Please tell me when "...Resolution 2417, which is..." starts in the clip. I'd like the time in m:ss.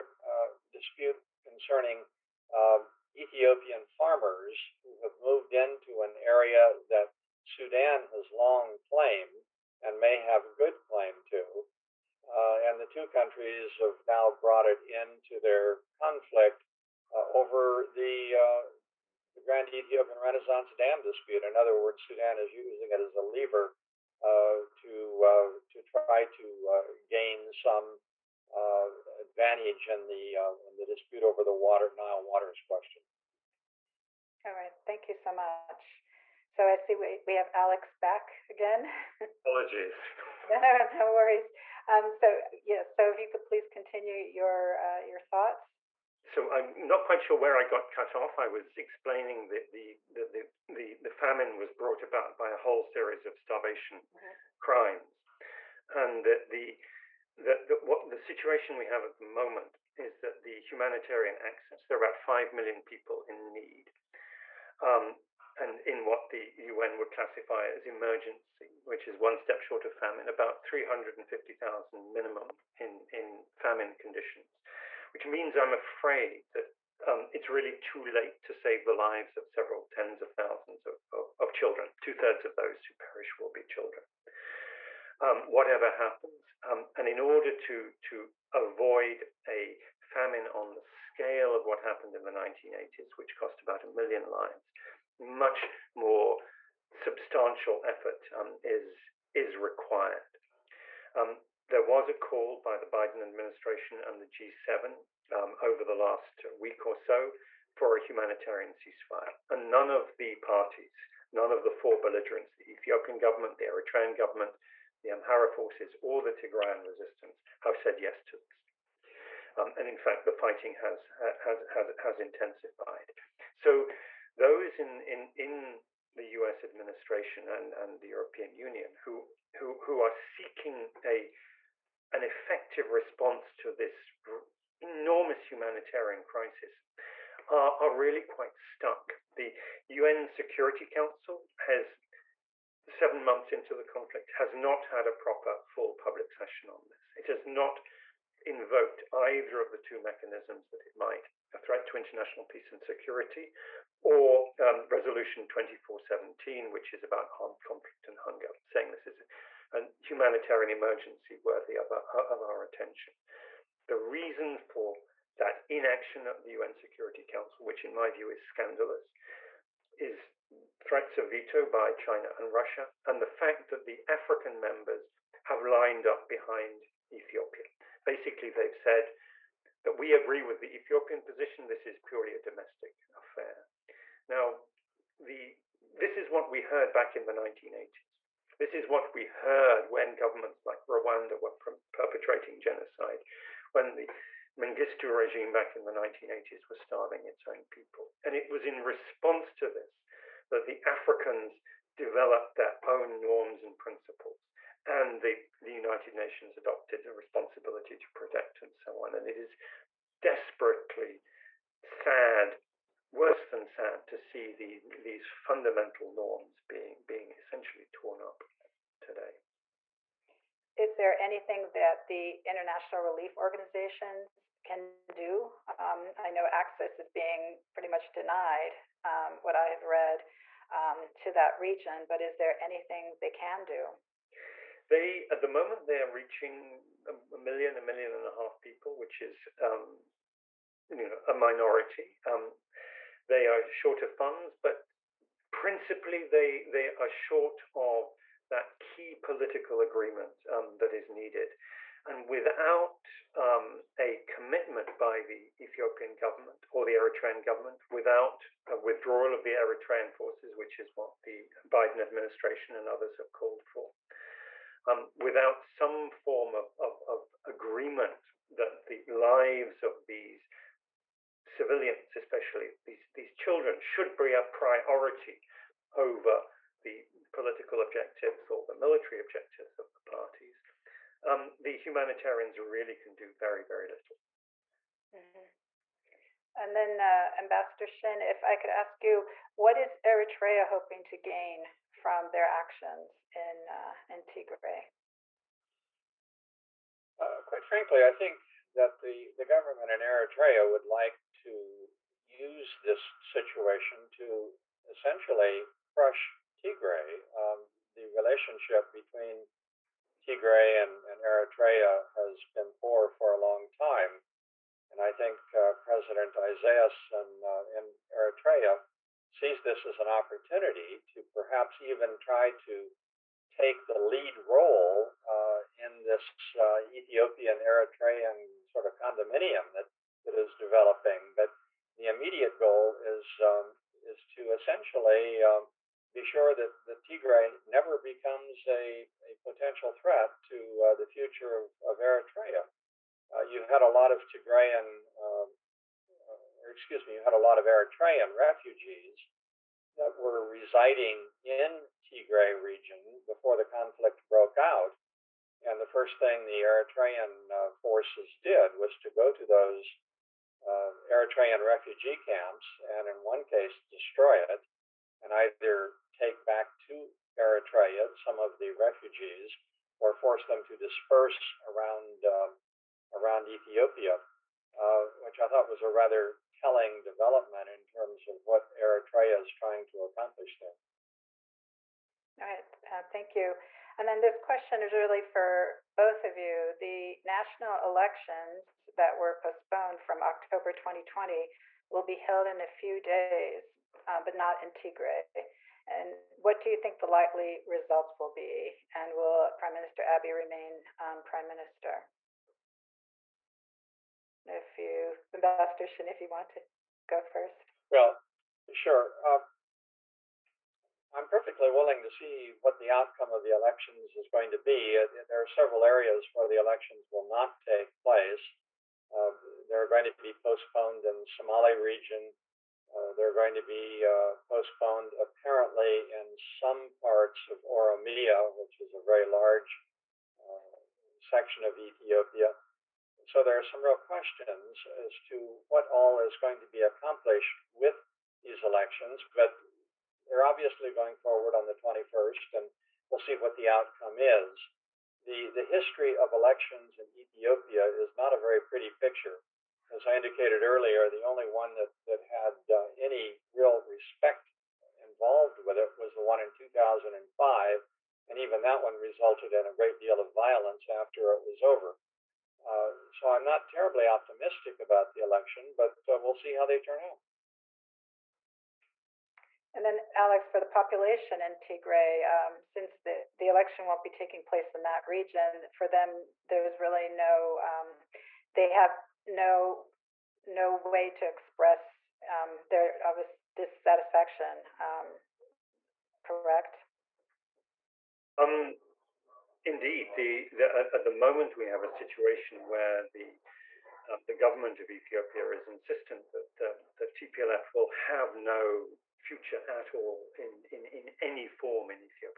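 2:34.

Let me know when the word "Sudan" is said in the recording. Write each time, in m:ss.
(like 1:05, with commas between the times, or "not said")
0:07, 0:22.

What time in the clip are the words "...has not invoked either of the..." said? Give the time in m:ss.
2:27.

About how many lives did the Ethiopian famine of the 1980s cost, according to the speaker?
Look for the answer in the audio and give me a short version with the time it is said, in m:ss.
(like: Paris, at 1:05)
About a million, at 1:33.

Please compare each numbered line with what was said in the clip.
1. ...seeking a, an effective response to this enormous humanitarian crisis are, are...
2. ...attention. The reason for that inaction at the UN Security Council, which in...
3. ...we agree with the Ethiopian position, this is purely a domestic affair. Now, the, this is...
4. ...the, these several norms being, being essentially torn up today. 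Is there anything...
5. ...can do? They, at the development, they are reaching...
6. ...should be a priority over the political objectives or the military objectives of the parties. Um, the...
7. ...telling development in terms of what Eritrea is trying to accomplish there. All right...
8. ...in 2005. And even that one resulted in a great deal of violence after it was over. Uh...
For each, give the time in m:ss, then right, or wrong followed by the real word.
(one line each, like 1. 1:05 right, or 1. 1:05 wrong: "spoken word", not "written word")
1. 2:10 right
2. 2:42 right
3. 2:59 right
4. 3:34 wrong: "fundamental", not "several"
5. 3:53 wrong: "moment", not "development"
6. 4:33 right
7. 6:16 right
8. 7:36 right.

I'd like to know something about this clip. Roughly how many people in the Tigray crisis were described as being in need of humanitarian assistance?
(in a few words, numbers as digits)
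5 million.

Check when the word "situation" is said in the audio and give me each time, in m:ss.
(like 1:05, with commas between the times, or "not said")
0:58, 5:03, 8:11.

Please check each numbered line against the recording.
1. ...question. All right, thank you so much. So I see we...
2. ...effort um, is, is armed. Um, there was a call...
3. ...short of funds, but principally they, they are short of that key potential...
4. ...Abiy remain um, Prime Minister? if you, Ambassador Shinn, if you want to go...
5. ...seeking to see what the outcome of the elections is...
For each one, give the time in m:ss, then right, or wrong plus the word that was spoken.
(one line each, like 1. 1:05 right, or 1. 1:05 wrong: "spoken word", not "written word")
1. 0:32 right
2. 1:37 wrong: "required", not "armed"
3. 4:03 wrong: "political", not "potential"
4. 6:40 right
5. 6:51 wrong: "willing", not "seeking".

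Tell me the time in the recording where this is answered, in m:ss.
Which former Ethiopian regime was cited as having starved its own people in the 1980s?
3:14.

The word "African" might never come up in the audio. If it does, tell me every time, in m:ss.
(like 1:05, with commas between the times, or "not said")
2:54, 3:20.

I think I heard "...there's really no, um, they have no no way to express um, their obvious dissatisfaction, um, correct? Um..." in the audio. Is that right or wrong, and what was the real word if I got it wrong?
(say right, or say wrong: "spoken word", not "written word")
right.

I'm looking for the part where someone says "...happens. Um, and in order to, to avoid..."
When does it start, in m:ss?
1:25.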